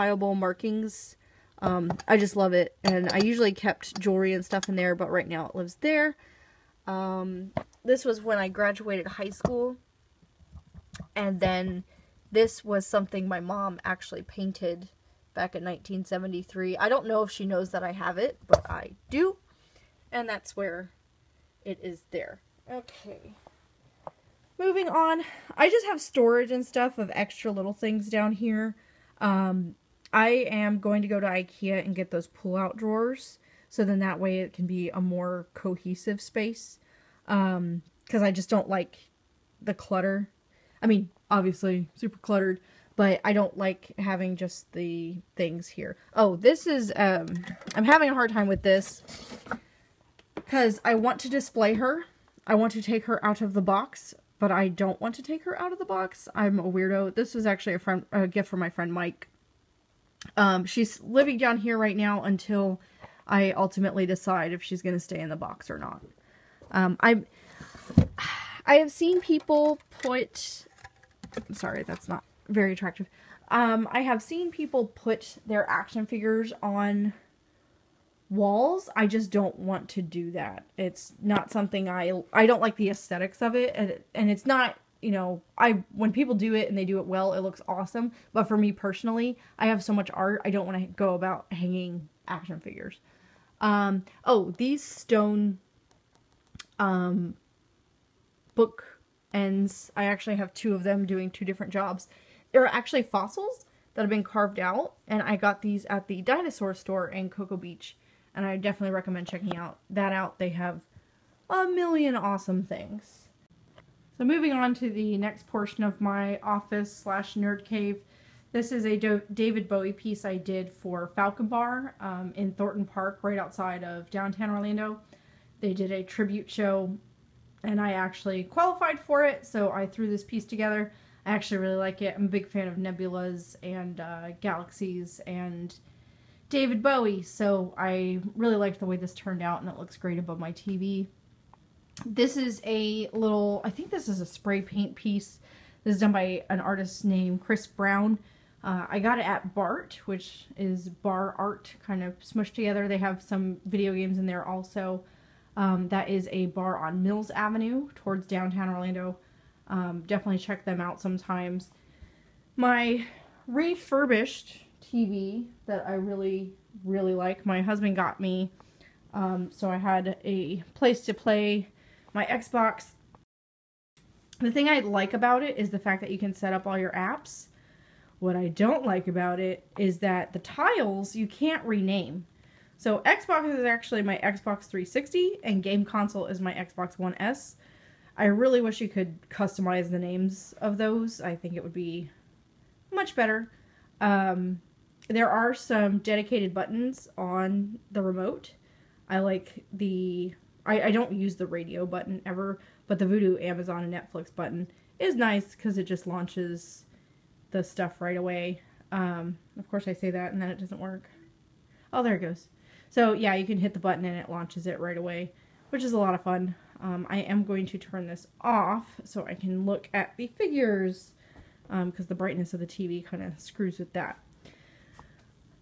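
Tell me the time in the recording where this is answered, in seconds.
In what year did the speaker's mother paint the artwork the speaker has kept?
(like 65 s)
15 s.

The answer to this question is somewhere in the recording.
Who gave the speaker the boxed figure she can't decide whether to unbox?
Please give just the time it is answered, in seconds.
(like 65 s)
58 s.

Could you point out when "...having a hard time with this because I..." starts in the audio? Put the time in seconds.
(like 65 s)
47 s.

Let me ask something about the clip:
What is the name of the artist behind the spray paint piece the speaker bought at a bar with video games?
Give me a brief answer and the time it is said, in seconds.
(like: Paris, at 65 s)
Chris Brown, at 147 s.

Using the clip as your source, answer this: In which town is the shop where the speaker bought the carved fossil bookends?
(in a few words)
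Cocoa Beach.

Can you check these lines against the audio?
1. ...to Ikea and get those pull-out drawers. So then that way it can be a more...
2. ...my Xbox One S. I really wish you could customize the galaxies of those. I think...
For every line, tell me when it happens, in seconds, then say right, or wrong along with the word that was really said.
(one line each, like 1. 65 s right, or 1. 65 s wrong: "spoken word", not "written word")
1. 31 s right
2. 186 s wrong: "names", not "galaxies".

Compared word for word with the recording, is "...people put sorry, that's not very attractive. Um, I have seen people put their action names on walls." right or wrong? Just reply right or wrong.
wrong.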